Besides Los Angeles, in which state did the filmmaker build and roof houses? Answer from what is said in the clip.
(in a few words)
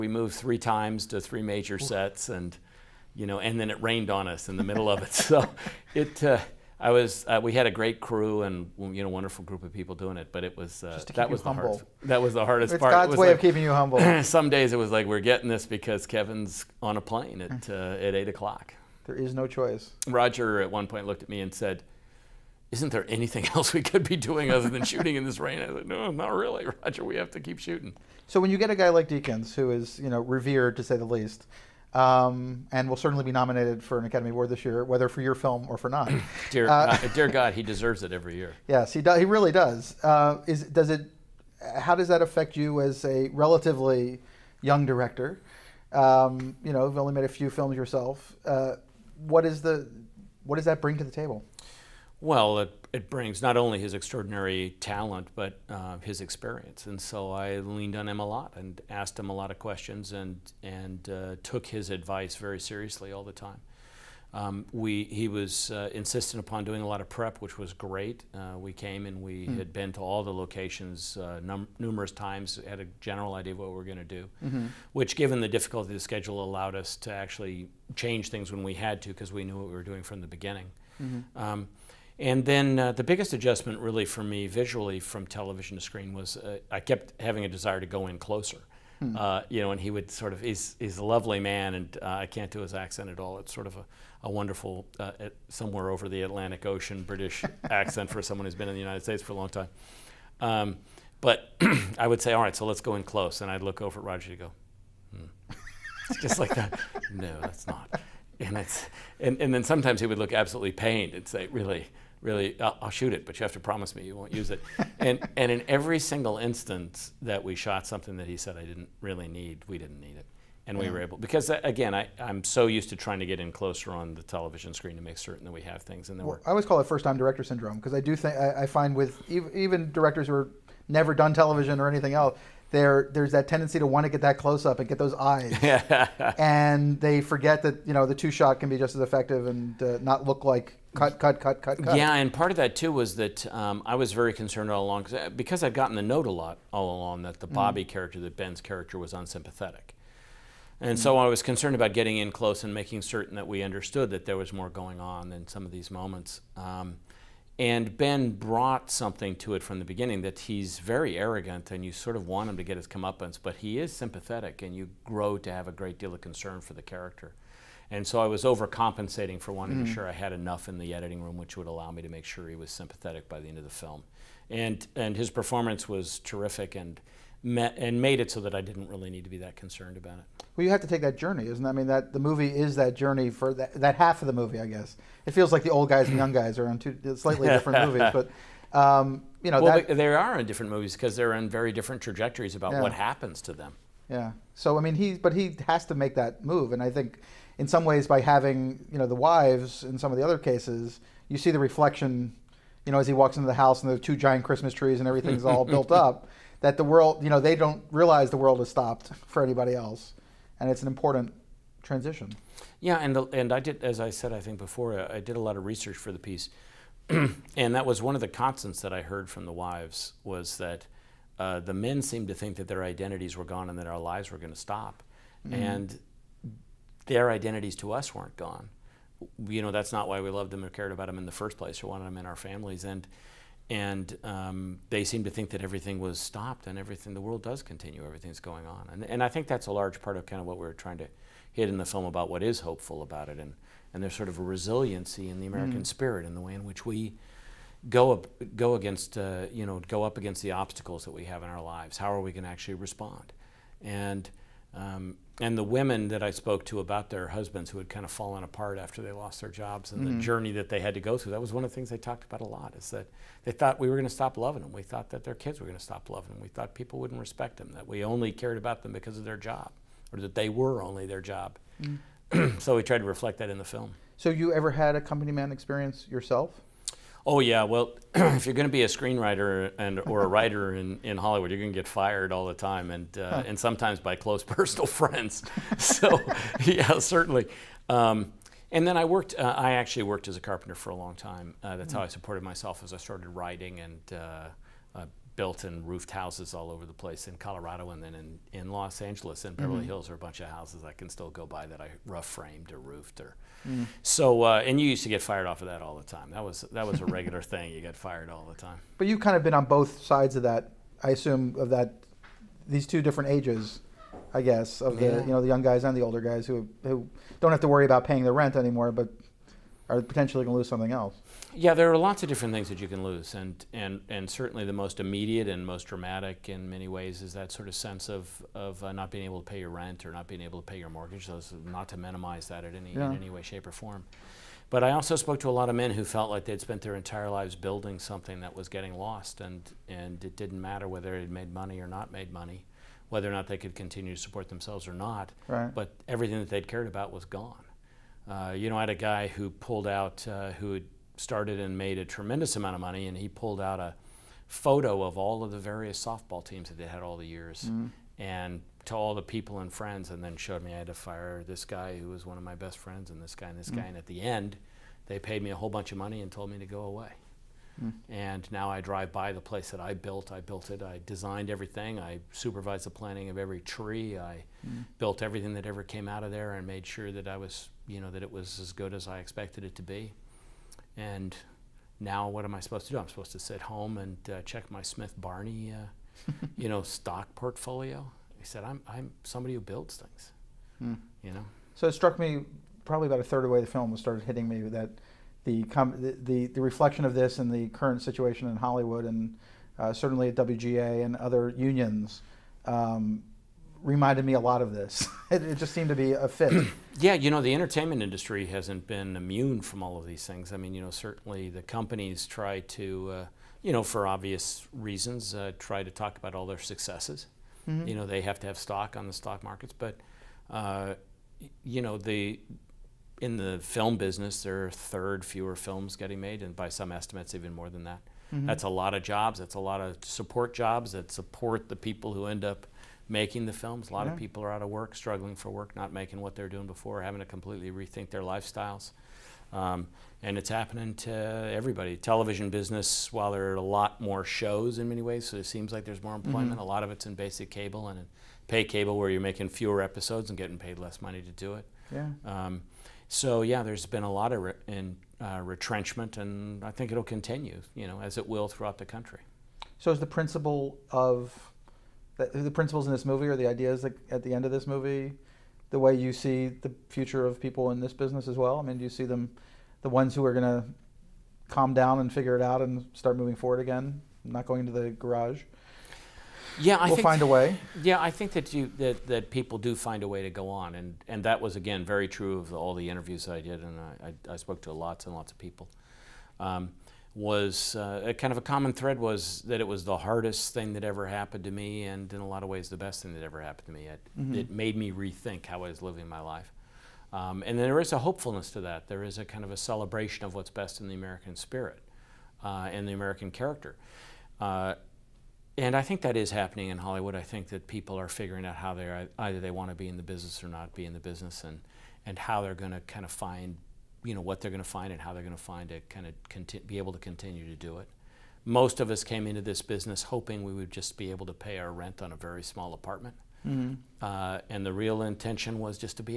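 Colorado.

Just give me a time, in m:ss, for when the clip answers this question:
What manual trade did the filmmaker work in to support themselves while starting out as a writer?
4:50.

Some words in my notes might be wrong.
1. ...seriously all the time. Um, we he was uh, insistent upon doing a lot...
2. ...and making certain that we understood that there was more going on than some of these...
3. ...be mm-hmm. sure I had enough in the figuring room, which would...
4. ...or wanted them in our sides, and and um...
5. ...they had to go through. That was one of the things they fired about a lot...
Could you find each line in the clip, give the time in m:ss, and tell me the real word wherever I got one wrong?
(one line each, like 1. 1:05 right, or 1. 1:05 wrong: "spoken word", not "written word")
1. 1:02 right
2. 2:32 right
3. 2:49 wrong: "editing", not "figuring"
4. 3:51 wrong: "families", not "sides"
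5. 4:20 wrong: "talked", not "fired".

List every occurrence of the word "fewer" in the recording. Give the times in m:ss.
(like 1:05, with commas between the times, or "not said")
7:05, 7:29.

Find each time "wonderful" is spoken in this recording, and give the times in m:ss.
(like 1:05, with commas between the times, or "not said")
0:09, 1:34.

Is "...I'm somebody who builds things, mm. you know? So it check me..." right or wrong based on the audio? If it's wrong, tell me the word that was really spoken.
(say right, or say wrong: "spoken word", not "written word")
wrong: "struck", not "check".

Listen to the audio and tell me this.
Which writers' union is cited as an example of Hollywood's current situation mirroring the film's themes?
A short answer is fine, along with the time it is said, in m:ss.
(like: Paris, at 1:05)
WGA, at 6:40.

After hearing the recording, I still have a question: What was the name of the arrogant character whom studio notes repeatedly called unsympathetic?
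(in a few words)
Bobby.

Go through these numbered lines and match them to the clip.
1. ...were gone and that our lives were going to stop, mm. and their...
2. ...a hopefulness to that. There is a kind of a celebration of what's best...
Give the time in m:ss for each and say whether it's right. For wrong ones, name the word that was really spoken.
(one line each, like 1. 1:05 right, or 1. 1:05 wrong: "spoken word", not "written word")
1. 3:43 right
2. 8:17 right.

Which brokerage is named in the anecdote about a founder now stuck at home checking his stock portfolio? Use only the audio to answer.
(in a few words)
Smith Barney.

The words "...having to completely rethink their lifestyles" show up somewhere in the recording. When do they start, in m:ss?
7:17.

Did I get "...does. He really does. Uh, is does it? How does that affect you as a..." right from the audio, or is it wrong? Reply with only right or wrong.
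right.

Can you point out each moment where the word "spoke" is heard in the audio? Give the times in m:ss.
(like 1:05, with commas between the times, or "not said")
4:16, 5:35, 8:04.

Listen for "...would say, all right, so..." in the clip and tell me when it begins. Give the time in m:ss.
1:42.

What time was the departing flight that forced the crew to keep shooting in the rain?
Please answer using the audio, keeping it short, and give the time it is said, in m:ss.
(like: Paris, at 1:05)
8 o'clock, at 0:18.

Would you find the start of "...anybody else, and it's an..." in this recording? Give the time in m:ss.
3:29.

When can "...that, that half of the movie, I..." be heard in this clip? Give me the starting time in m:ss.
3:03.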